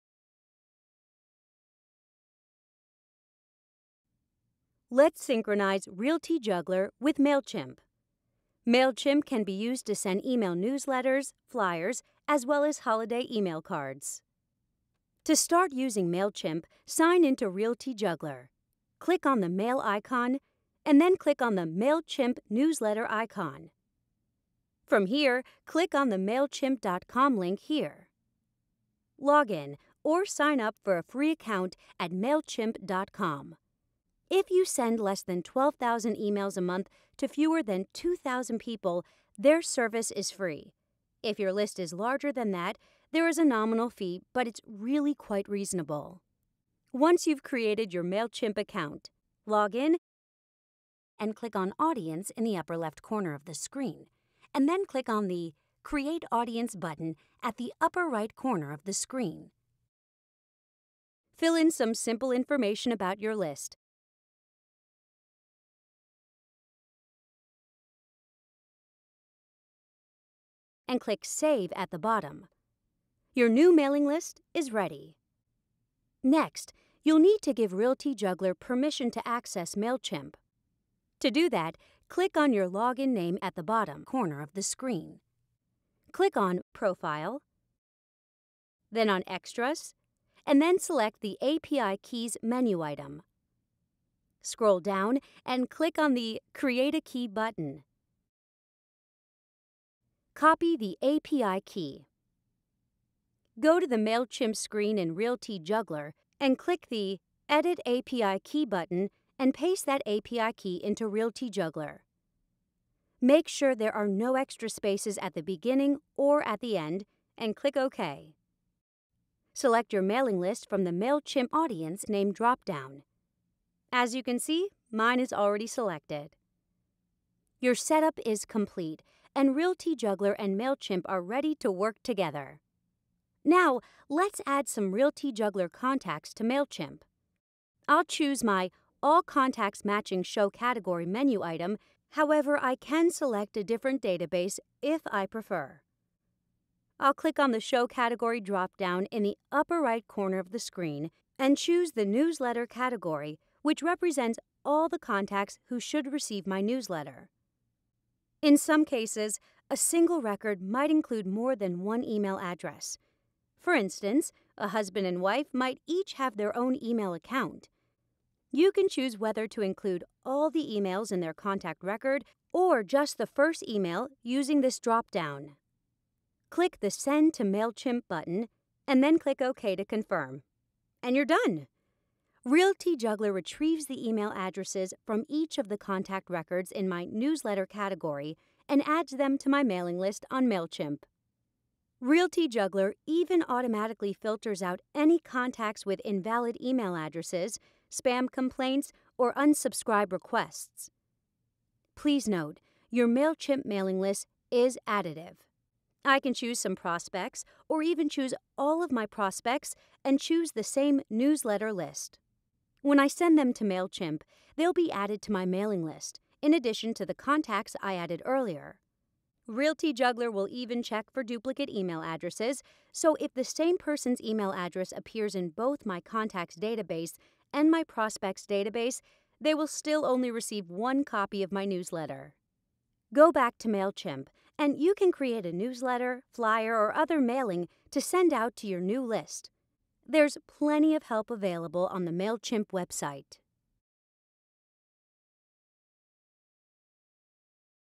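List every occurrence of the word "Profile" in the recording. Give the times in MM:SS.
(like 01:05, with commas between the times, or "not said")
01:26.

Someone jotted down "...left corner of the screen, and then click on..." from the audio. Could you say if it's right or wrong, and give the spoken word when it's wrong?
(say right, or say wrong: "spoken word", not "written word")
right.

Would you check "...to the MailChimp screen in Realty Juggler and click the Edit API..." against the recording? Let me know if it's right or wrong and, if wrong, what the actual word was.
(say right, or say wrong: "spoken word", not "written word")
right.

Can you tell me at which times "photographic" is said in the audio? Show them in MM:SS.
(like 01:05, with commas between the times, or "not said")
not said.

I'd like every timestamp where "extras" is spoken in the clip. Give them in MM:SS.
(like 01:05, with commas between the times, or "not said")
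01:29, 01:54.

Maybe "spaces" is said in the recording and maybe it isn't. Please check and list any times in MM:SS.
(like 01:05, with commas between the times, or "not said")
01:54.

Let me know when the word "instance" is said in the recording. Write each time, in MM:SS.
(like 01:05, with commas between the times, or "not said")
02:43.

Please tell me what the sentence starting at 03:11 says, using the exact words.
Realty Juggler even automatically filters out any contacts with invalid email addresses, spam complaints, or unsubscribe requests.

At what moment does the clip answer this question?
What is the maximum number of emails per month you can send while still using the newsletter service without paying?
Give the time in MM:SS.
00:35.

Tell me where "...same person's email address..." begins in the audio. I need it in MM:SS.
03:43.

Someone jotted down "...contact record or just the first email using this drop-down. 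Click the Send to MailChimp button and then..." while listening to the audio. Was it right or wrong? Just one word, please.
right.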